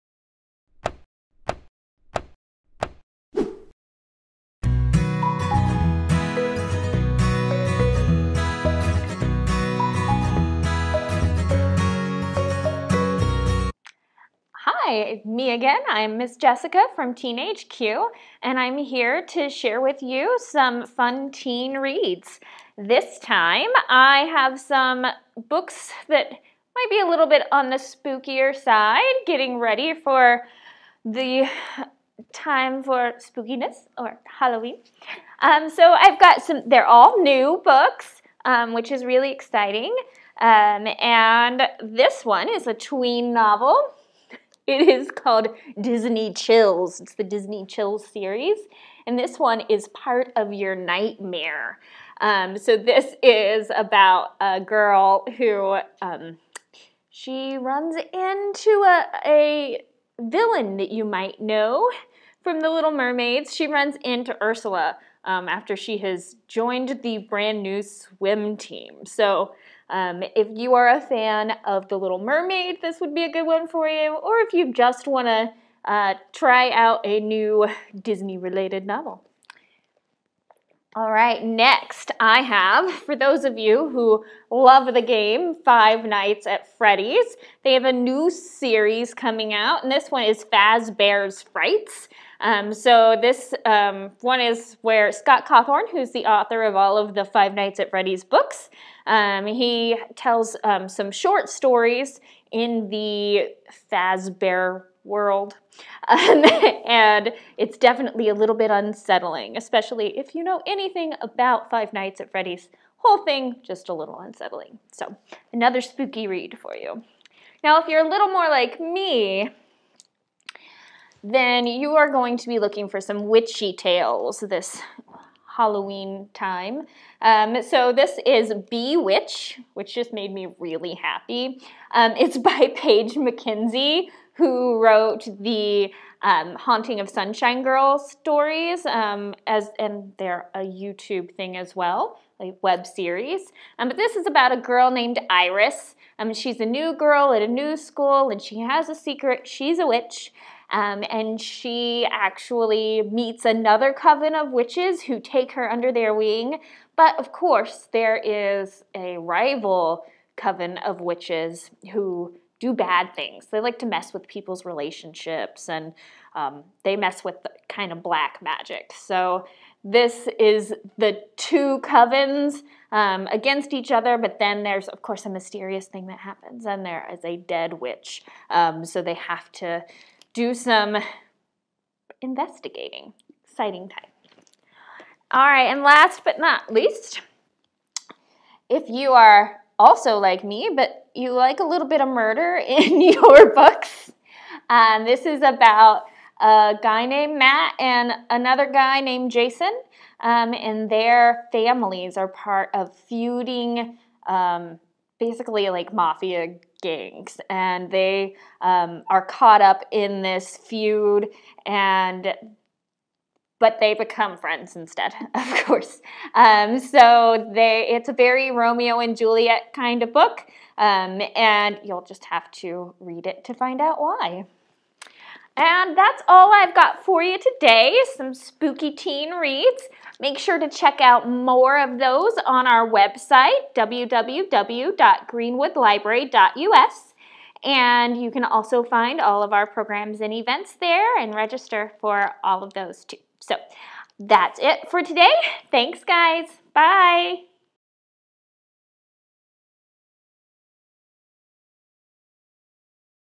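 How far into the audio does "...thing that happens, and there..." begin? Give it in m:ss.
2:55.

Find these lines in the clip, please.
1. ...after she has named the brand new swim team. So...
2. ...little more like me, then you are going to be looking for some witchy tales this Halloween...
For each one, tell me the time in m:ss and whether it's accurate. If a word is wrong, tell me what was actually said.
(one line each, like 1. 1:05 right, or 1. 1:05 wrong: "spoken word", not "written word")
1. 1:05 wrong: "joined", not "named"
2. 1:58 right.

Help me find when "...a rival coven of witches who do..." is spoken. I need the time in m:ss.
2:38.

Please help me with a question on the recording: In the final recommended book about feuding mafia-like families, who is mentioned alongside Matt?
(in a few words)
Jason.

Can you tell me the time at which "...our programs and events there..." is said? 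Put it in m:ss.
3:59.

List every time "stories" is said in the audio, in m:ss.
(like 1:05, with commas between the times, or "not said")
1:41, 2:17.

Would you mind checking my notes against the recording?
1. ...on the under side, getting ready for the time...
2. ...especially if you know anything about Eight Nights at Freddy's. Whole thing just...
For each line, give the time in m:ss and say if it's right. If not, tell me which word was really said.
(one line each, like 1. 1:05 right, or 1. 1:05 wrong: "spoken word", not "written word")
1. 0:27 wrong: "spookier", not "under"
2. 1:49 wrong: "Five", not "Eight".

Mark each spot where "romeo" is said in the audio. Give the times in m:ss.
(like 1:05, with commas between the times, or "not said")
3:38.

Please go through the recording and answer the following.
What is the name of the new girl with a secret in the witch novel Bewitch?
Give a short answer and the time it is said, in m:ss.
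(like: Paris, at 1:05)
Iris, at 2:25.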